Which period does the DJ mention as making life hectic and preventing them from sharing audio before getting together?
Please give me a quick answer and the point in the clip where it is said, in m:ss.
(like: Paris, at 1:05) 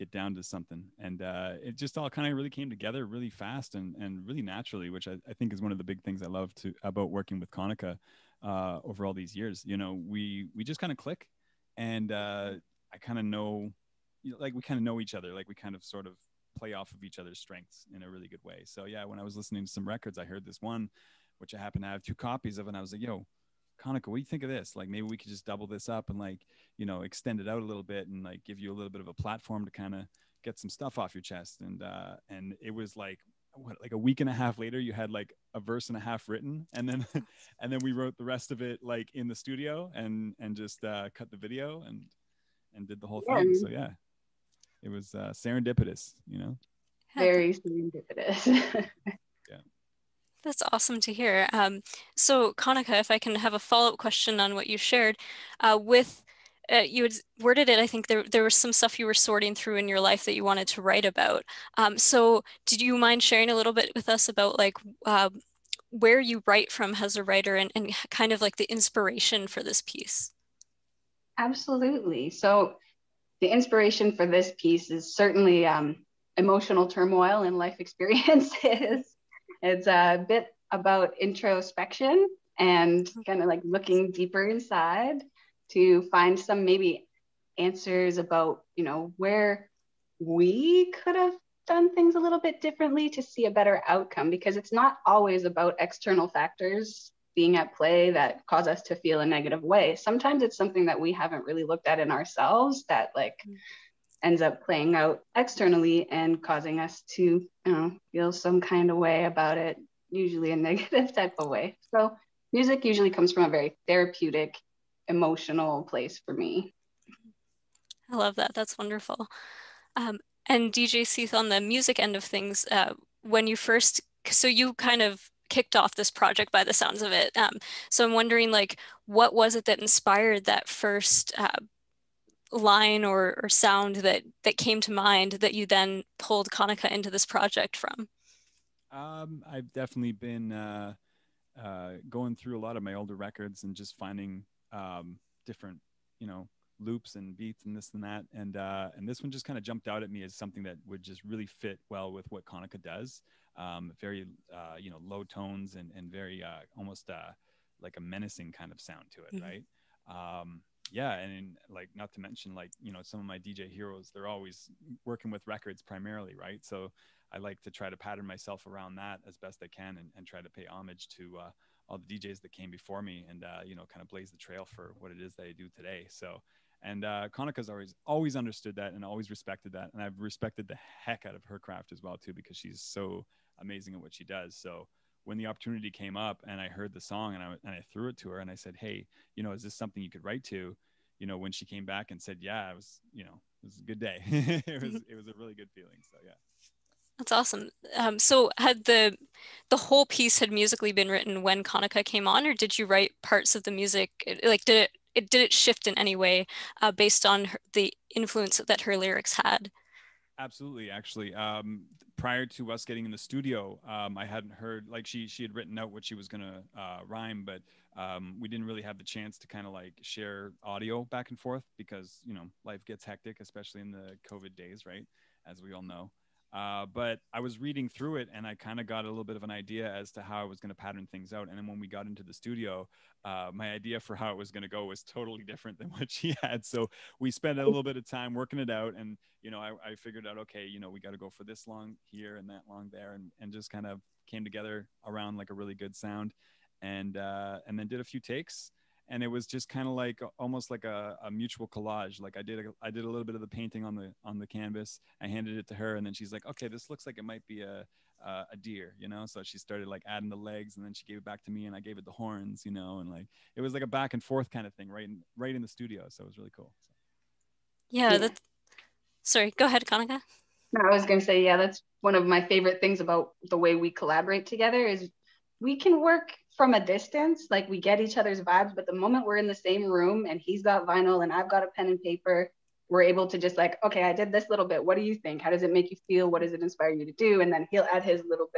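The COVID days, at 3:44.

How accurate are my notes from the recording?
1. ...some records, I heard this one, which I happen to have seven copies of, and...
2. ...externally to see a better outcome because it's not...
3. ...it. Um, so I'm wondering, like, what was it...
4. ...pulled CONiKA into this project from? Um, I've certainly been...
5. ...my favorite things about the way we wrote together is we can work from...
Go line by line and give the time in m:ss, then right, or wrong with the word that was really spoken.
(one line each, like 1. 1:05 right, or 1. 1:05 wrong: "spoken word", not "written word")
1. 0:19 wrong: "two", not "seven"
2. 1:32 wrong: "differently", not "externally"
3. 2:07 right
4. 2:16 wrong: "definitely", not "certainly"
5. 4:32 wrong: "collaborate", not "wrote".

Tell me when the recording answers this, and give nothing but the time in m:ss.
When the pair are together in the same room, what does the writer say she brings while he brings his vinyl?
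4:41.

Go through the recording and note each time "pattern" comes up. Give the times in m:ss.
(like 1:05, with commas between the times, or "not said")
2:47, 3:50.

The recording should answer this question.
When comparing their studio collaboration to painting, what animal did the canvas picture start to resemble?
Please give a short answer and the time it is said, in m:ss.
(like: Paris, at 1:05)
A deer, at 4:18.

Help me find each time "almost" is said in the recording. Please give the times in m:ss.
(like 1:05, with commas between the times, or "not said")
2:36, 4:10.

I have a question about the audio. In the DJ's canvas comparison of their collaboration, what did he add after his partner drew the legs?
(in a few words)
The horns.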